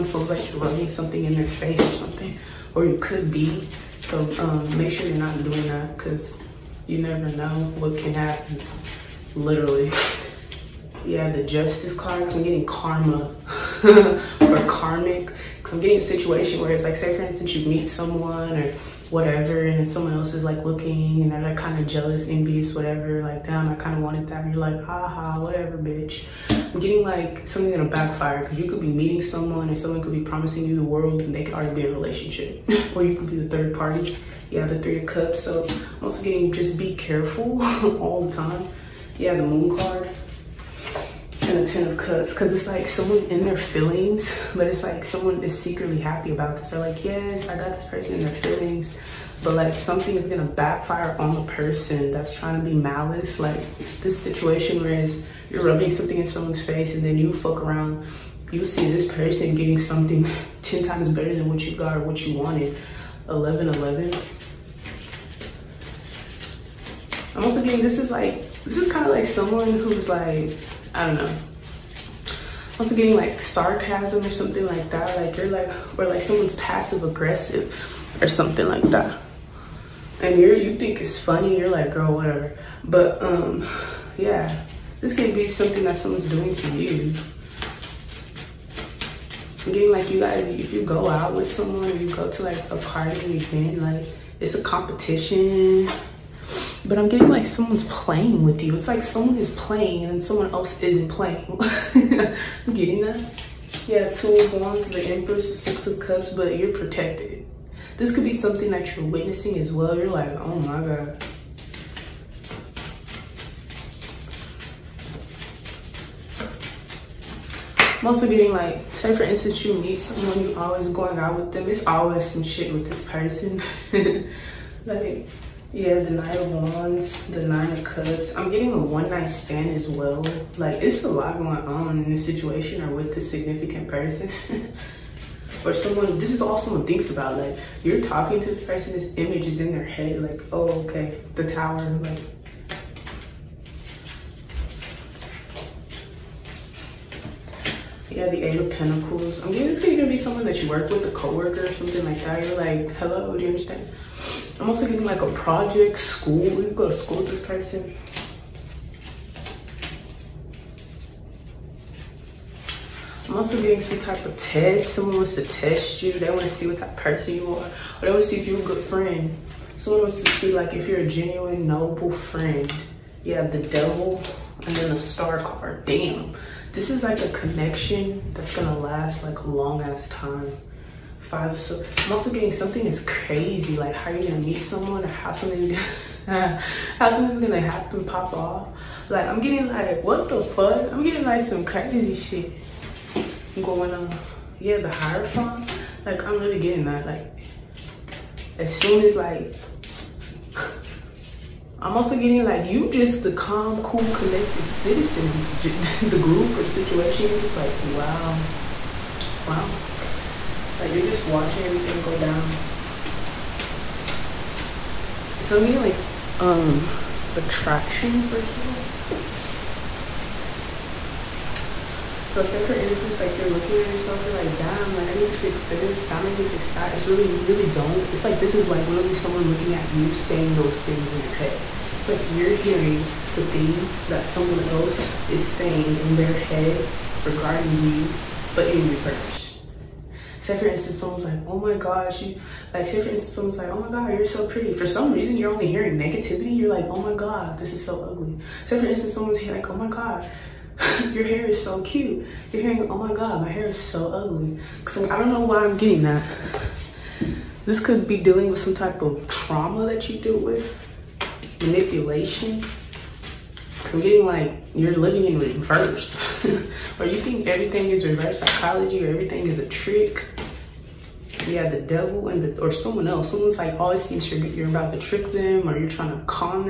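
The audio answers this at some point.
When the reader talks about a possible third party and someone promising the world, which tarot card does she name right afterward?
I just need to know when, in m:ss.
0:34.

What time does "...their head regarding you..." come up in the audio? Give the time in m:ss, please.
3:56.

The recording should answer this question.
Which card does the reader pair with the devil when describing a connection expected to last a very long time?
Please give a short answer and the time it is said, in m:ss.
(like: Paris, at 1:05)
The Star, at 2:54.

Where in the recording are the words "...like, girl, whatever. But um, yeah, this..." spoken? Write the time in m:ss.
1:21.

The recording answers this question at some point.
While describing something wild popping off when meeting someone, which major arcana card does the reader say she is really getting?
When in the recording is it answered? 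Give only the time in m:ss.
3:14.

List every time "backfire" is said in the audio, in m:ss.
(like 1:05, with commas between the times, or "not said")
0:27, 0:50.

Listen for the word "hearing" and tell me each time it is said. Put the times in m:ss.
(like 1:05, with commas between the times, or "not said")
3:52, 4:05, 4:12.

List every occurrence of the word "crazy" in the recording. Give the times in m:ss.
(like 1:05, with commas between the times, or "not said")
3:03, 3:11.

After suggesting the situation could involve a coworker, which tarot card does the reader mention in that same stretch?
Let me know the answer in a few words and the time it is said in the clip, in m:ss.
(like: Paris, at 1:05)
Eight of Pentacles, at 2:28.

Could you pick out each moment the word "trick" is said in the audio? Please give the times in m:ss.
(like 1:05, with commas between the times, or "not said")
4:29, 4:34.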